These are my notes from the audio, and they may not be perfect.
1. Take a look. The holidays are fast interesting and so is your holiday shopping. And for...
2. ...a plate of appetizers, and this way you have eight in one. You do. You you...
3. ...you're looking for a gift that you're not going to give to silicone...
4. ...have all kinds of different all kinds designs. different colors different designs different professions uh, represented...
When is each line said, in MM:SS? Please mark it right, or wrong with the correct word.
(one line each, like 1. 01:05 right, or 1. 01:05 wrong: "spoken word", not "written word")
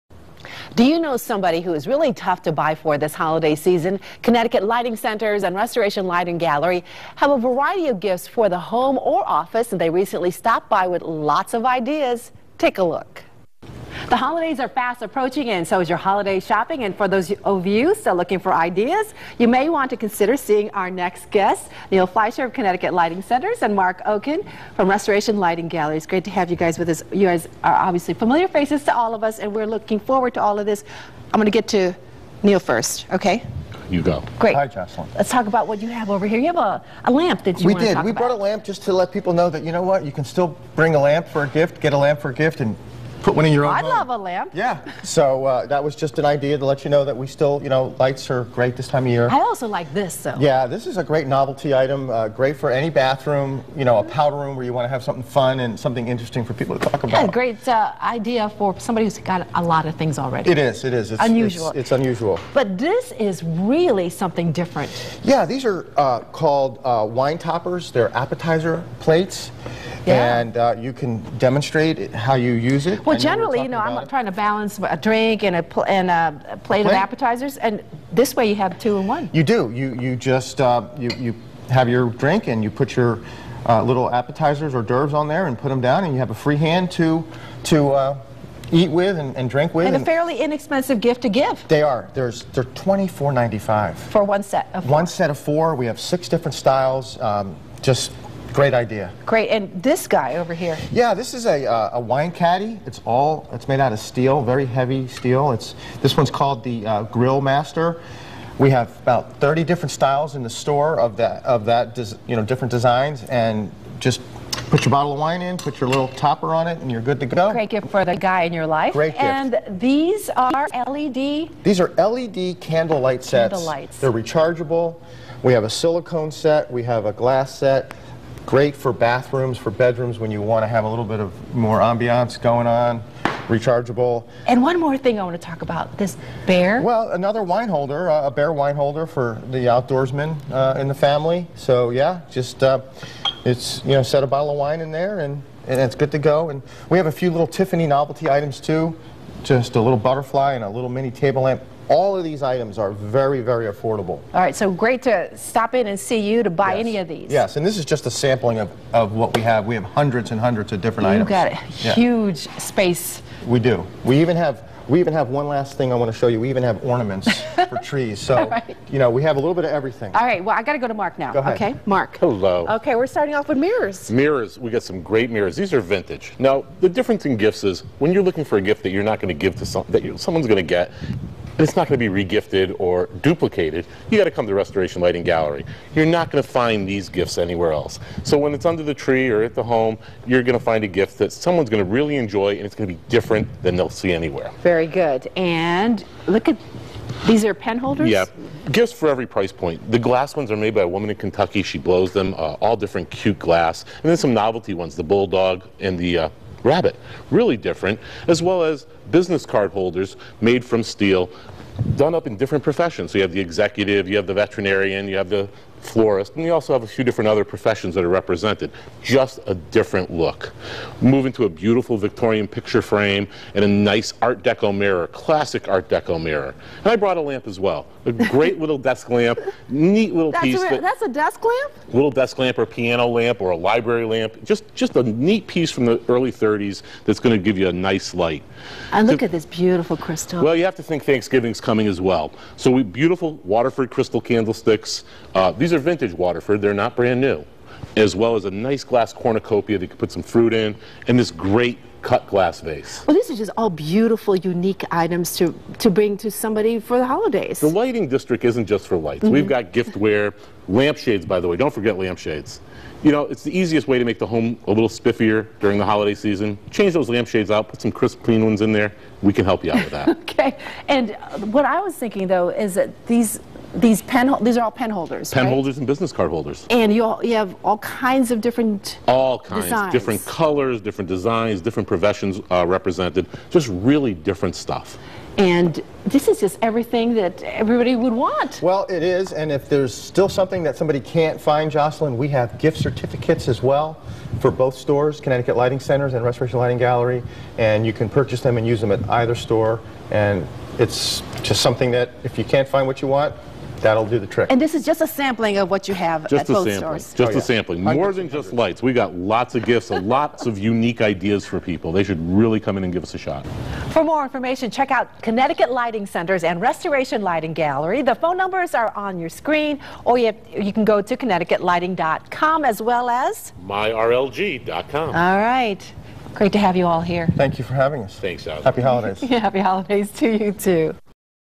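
1. 00:12 wrong: "approaching", not "interesting"
2. 01:16 wrong: "two", not "eight"
3. 02:58 wrong: "someone", not "silicone"
4. 04:37 right.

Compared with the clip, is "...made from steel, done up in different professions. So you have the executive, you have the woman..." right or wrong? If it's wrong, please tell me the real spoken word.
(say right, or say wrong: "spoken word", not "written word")
wrong: "veterinarian", not "woman".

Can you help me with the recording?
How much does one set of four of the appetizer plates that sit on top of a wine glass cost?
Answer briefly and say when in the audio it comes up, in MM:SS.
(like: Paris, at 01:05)
$24.95, at 01:32.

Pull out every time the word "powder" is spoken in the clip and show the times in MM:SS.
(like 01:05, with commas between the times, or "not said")
00:54.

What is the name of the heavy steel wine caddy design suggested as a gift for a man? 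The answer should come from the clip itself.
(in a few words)
Grill Master.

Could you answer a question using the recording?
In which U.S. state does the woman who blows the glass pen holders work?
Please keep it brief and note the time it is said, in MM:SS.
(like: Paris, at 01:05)
Kentucky, at 03:21.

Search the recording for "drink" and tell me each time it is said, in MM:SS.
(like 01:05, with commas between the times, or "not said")
01:14, 01:22, 01:29.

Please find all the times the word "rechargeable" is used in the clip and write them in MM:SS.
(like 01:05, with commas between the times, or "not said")
02:04, 02:13.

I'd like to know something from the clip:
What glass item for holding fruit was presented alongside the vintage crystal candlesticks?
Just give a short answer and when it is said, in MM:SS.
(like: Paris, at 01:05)
cornucopia, at 04:09.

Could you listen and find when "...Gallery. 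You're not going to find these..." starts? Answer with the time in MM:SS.
03:05.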